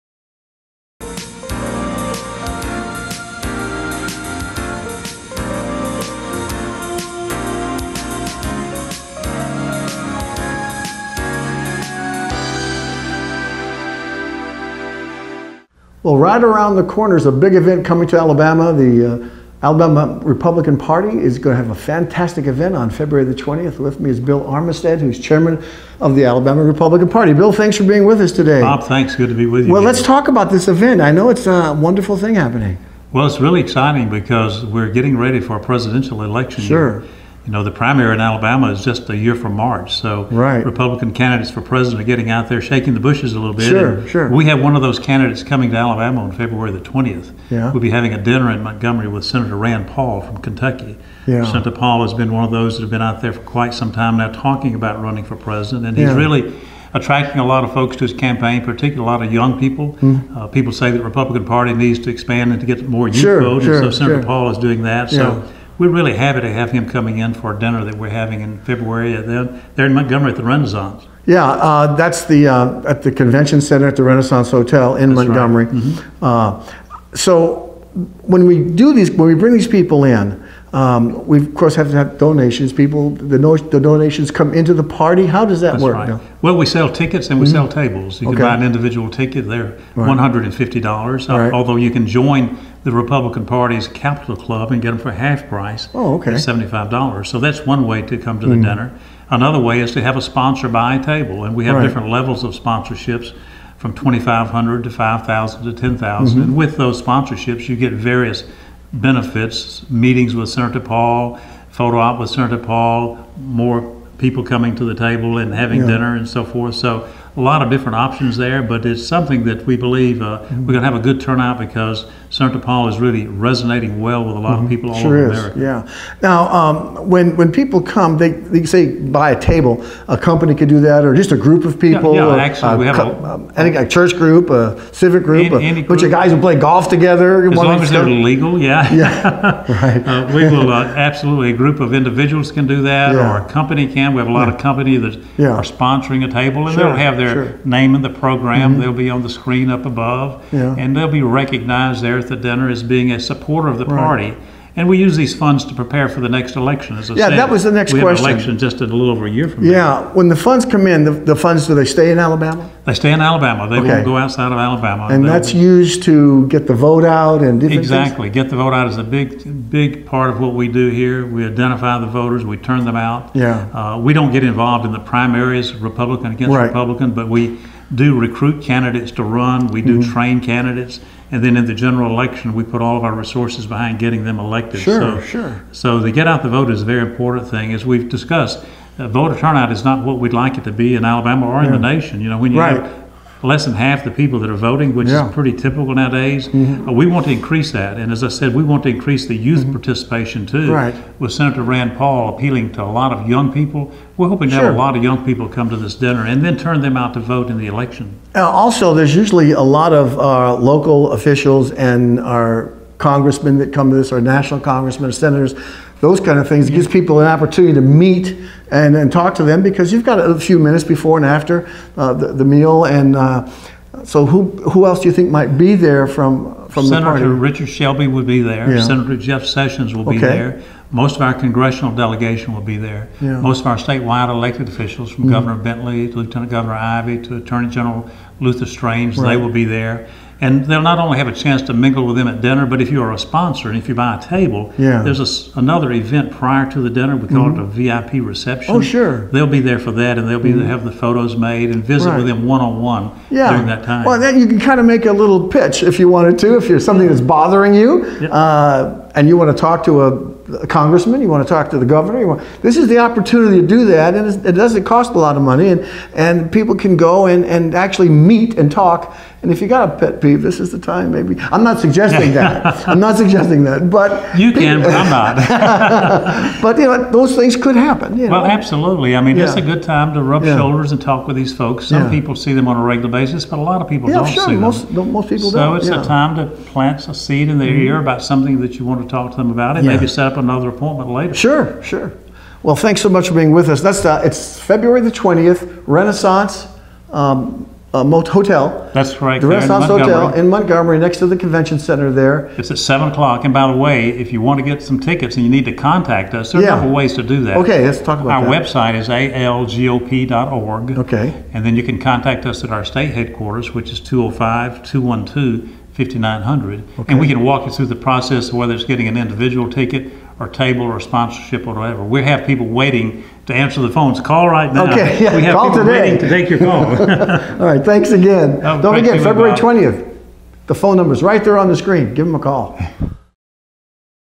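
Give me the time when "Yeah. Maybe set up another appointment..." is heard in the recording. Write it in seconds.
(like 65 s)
289 s.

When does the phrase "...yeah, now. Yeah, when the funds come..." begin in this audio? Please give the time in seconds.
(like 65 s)
159 s.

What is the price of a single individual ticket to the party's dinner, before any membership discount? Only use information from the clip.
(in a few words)
$150.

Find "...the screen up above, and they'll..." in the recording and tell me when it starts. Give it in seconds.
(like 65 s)
149 s.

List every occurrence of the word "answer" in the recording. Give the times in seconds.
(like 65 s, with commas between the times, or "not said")
323 s.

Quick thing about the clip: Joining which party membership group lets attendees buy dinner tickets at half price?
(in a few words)
Capital Club.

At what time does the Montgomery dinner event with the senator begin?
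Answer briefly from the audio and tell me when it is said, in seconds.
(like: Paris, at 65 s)
7 o'clock, at 302 s.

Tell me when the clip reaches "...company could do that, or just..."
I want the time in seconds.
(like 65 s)
130 s.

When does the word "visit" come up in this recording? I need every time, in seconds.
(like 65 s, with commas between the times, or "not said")
251 s.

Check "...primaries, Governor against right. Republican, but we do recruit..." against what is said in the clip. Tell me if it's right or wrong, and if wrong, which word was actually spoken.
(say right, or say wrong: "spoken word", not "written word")
wrong: "Republican", not "Governor".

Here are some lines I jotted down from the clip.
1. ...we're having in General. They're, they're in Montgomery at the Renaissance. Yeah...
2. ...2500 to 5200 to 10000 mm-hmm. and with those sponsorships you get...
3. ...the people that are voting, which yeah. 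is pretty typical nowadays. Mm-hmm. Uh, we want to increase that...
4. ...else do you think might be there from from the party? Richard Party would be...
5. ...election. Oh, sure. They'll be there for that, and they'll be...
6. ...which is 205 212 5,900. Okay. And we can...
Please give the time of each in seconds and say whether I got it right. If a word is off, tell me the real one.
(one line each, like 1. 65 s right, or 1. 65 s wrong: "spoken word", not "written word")
1. 67 s wrong: "February", not "General"
2. 103 s wrong: "5000", not "5200"
3. 194 s right
4. 224 s wrong: "Shelby", not "Party"
5. 248 s wrong: "reception", not "election"
6. 313 s right.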